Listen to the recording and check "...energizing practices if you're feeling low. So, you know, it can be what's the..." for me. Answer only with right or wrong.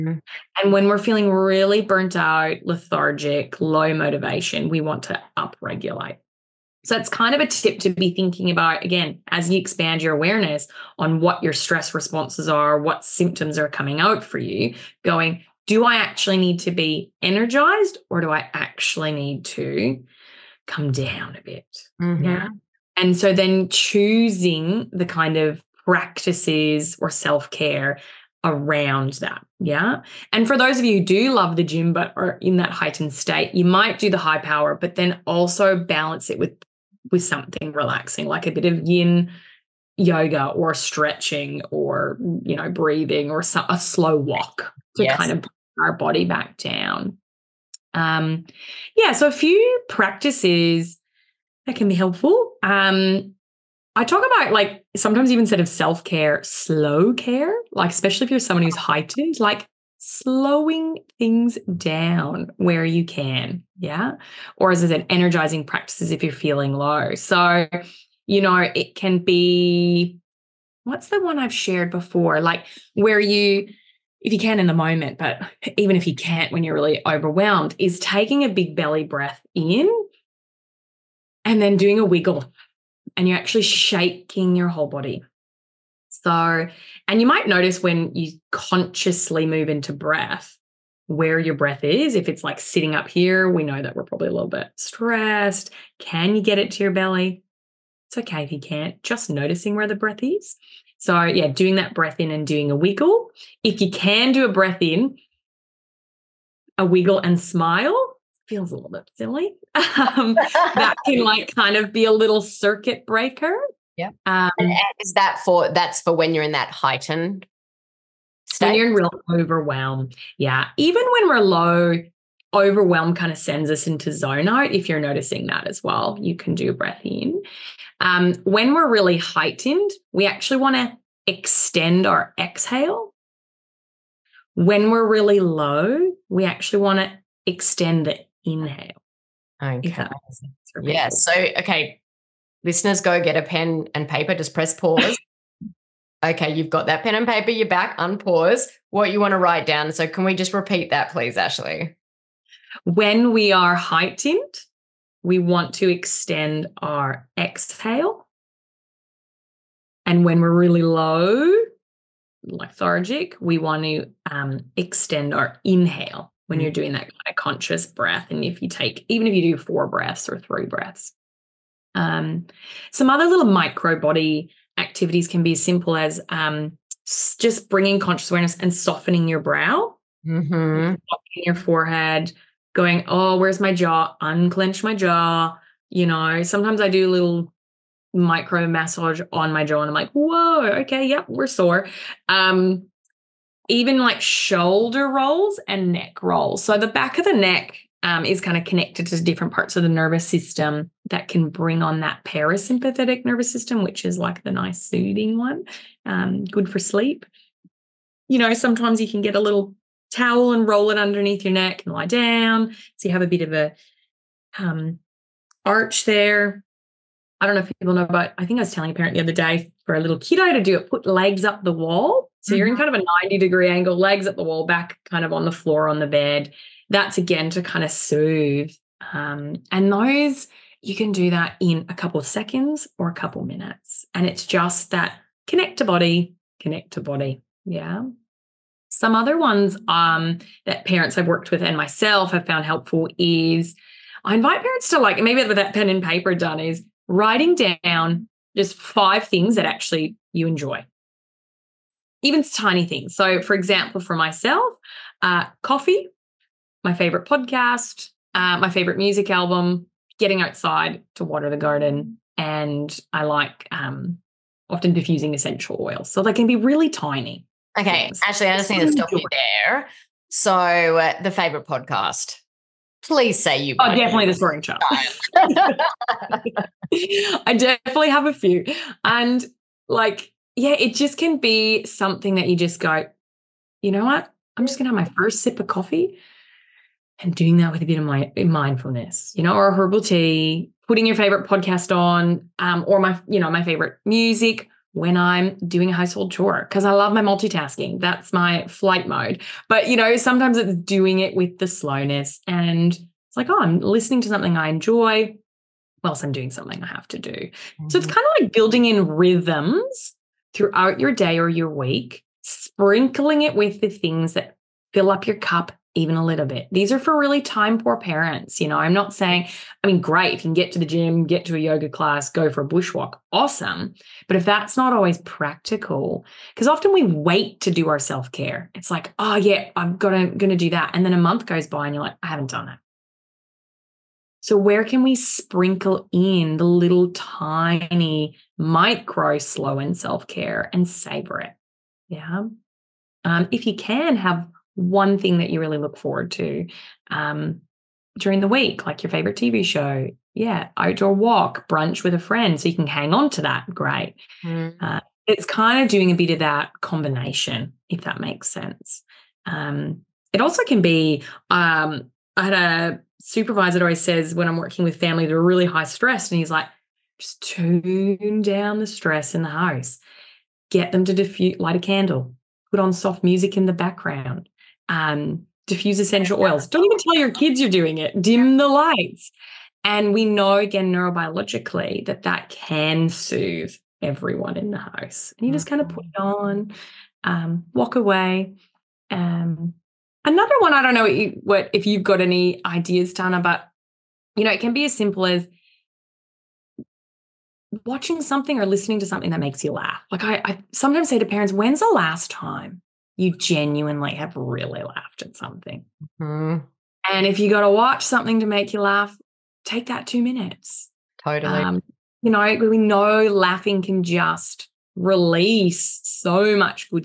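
right.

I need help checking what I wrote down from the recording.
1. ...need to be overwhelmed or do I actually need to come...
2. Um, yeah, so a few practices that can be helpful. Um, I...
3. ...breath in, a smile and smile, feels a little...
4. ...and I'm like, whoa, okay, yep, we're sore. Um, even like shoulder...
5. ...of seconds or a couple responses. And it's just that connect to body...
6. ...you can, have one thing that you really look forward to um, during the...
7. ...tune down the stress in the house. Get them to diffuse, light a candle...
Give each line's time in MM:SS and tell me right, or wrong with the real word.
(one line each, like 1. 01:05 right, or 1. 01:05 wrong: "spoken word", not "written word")
1. 00:16 wrong: "energized", not "overwhelmed"
2. 00:47 right
3. 01:44 wrong: "wiggle", not "smile"
4. 03:09 right
5. 03:52 wrong: "minutes", not "responses"
6. 05:43 right
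7. 06:07 right.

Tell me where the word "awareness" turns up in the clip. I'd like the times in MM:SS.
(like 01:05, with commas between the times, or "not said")
00:10, 02:58.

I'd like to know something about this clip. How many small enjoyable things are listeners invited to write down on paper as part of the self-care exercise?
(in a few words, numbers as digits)
5.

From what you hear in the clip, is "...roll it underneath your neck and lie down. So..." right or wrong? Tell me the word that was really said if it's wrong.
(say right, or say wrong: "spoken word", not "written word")
right.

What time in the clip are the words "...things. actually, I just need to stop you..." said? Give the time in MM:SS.
04:28.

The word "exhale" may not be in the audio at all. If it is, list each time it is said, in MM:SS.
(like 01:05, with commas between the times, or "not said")
02:12, 02:37.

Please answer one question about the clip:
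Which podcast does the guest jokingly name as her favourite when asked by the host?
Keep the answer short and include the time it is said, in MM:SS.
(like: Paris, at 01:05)
The Soaring Child, at 04:34.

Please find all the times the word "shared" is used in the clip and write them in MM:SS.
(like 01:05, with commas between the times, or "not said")
01:11.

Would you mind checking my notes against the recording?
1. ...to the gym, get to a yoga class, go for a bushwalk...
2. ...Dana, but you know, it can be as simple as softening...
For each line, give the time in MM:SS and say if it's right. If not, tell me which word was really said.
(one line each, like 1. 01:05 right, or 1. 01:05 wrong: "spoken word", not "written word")
1. 05:20 right
2. 06:33 wrong: "watching", not "softening".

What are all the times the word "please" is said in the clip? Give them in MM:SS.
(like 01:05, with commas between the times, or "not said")
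02:31, 04:33.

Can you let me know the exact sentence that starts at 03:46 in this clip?
That's again to kind of soothe.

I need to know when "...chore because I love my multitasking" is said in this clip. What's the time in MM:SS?
04:56.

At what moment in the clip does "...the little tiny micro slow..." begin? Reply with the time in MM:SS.
05:36.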